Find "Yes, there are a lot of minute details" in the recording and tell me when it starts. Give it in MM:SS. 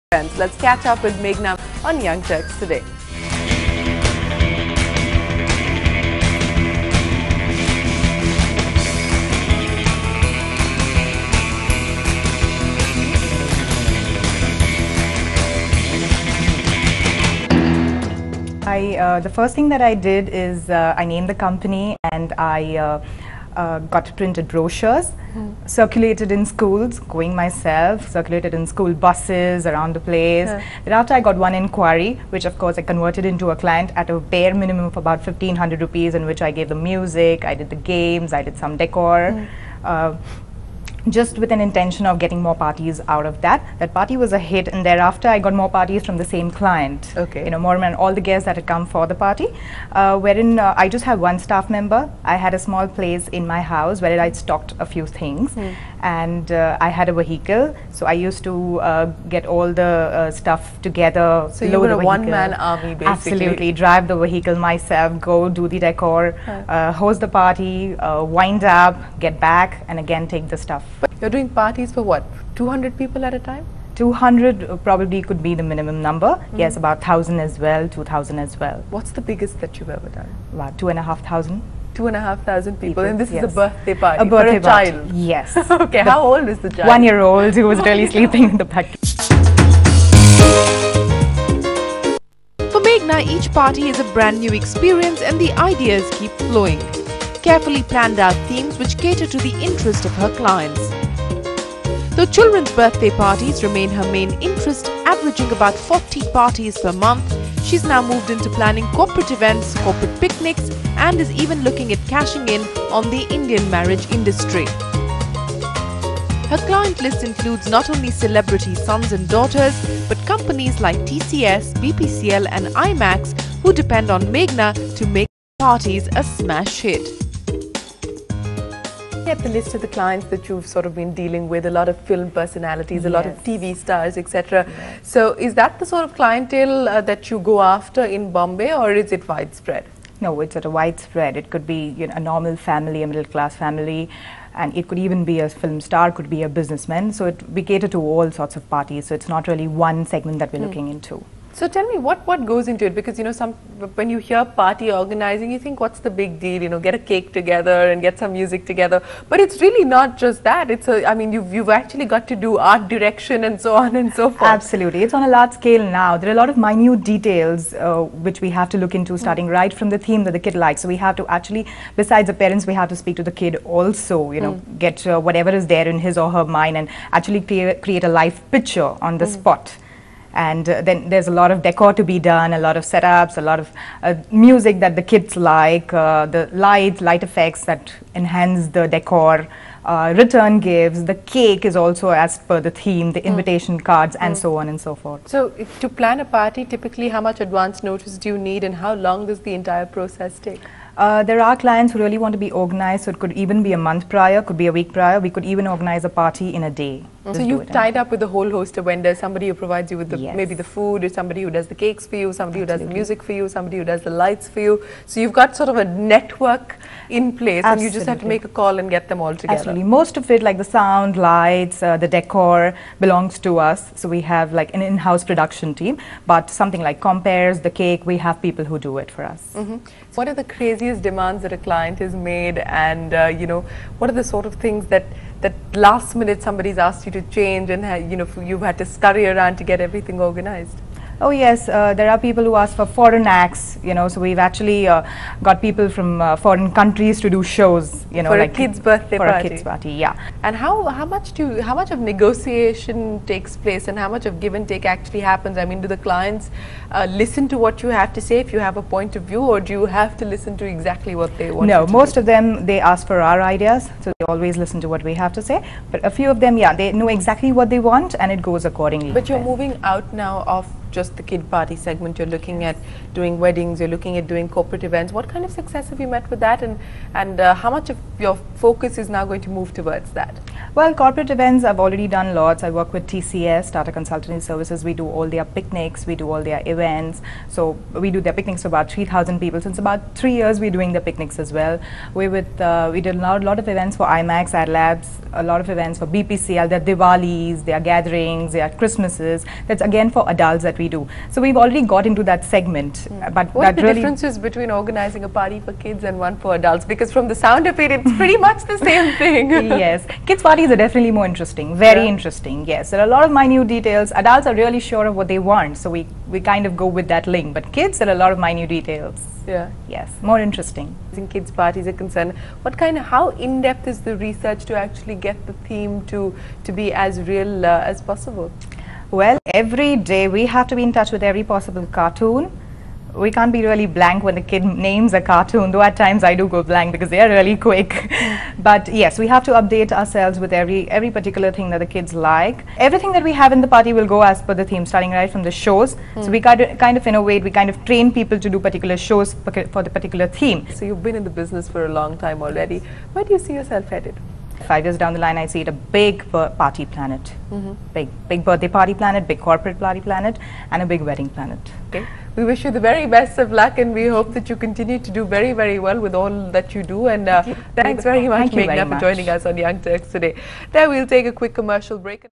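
05:12.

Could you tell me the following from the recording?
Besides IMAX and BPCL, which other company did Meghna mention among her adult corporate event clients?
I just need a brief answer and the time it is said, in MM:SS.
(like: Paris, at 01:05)
Ad Labs, at 04:54.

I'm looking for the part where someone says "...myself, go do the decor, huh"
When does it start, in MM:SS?
01:04.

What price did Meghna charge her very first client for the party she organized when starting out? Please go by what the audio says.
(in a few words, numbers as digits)
1500 rupees.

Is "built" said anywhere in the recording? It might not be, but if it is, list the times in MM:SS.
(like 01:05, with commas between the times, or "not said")
not said.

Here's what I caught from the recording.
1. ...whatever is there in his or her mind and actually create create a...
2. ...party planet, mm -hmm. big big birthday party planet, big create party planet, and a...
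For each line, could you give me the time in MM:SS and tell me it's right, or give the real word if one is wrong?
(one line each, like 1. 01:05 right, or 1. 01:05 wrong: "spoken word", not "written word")
1. 02:55 right
2. 05:56 wrong: "corporate", not "create".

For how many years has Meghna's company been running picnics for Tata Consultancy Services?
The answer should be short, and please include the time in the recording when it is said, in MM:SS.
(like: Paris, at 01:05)
3 years, at 04:50.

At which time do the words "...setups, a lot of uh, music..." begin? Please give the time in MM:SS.
03:02.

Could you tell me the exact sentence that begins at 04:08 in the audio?
For like a kid's birthday for party.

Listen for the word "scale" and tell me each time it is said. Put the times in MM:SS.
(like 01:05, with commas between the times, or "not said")
02:45.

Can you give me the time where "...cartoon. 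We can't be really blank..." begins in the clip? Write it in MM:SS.
05:31.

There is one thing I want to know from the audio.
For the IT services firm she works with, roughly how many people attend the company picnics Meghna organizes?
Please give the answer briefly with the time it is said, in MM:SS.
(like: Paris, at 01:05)
3,000, at 04:48.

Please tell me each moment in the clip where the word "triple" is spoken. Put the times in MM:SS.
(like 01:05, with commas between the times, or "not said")
not said.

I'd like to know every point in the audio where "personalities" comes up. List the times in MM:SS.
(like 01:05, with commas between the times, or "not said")
02:12.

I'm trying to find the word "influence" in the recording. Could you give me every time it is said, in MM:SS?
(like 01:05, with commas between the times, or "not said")
not said.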